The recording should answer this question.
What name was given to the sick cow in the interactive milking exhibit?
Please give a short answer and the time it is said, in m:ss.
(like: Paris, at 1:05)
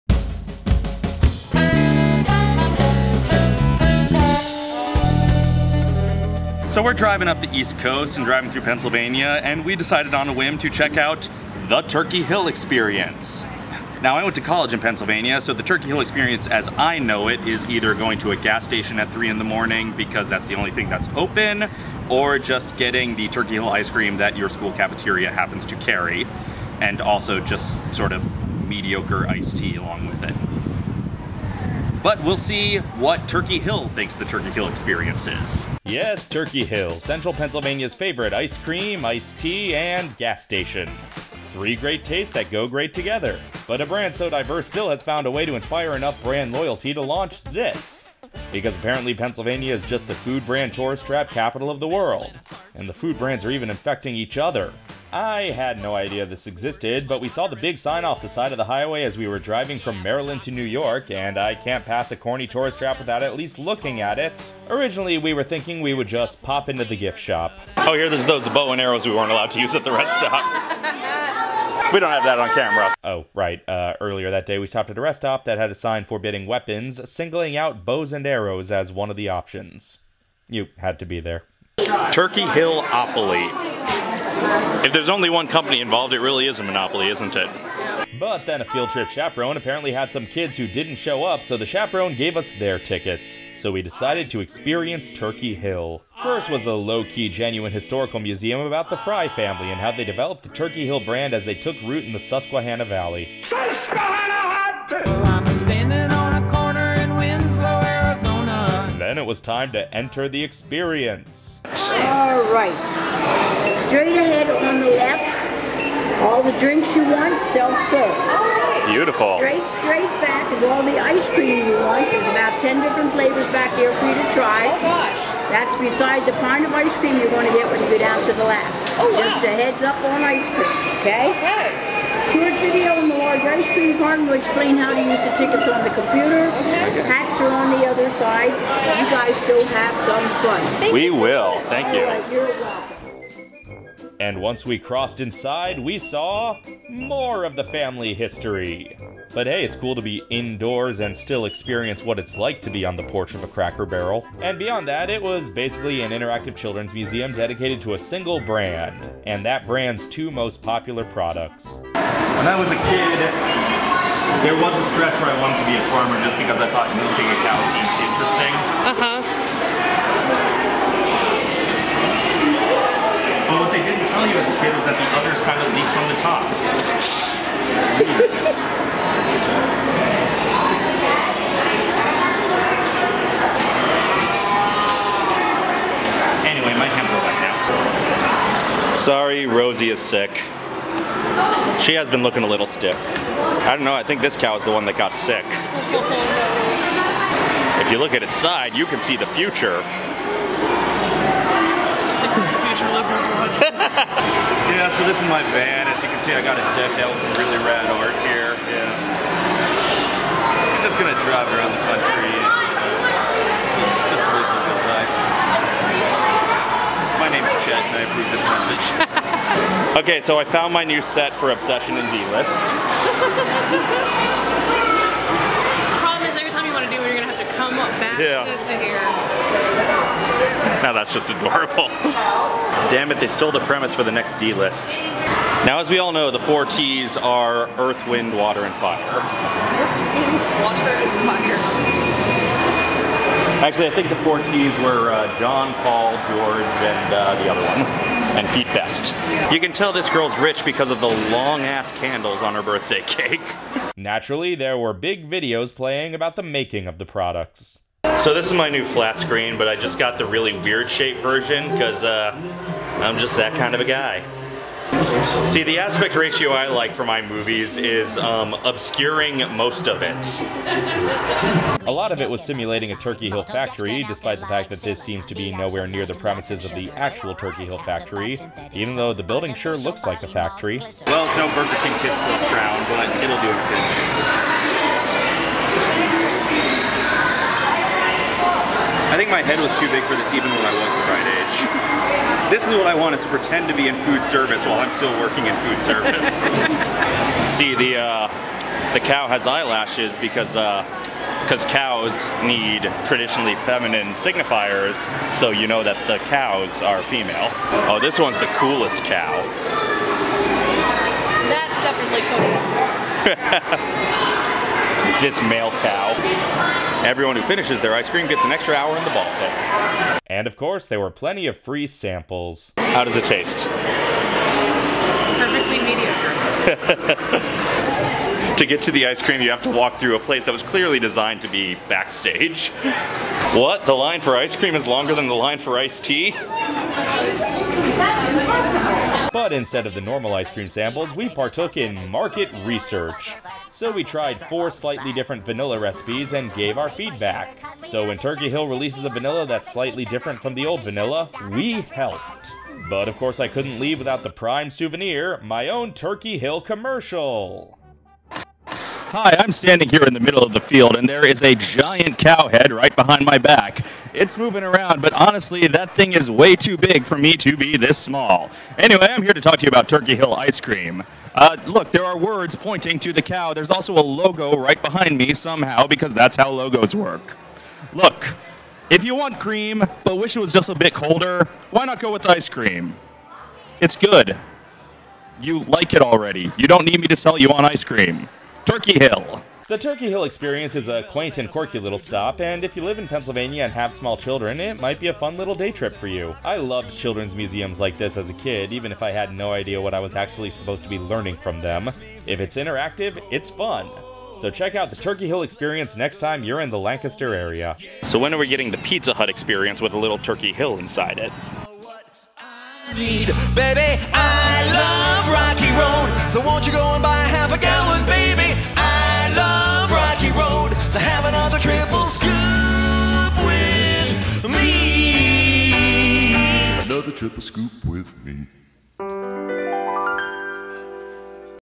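Rosie, at 3:09.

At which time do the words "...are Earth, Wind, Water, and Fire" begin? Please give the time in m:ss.
3:57.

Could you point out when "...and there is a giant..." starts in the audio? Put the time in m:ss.
6:00.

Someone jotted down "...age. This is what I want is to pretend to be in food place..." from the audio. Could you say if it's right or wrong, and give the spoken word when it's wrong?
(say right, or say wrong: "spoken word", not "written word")
wrong: "service", not "place".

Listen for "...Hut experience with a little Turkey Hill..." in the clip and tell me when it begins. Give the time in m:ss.
6:49.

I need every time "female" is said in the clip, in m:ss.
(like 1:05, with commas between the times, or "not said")
5:07.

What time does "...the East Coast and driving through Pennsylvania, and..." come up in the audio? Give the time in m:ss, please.
0:07.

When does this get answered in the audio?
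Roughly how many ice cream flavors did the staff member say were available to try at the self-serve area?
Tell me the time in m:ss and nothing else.
2:02.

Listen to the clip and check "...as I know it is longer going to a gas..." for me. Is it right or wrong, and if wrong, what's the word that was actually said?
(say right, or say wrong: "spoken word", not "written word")
wrong: "either", not "longer".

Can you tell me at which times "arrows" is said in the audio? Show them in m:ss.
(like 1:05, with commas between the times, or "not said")
1:08, 1:18.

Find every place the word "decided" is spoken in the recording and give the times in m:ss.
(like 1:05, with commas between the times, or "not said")
0:09, 1:33.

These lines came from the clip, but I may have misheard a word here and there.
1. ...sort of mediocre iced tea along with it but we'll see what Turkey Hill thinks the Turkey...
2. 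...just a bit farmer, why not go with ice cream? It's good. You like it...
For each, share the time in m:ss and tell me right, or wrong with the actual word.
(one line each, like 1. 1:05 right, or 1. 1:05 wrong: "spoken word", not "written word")
1. 0:27 right
2. 6:20 wrong: "colder", not "farmer".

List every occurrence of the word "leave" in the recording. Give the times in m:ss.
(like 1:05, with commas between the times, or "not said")
5:53.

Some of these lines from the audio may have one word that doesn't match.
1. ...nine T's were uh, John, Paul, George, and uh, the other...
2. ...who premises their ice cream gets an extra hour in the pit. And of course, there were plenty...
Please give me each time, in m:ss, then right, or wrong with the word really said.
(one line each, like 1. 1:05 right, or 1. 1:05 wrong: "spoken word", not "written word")
1. 4:04 wrong: "four", not "nine"
2. 5:17 wrong: "finishes", not "premises".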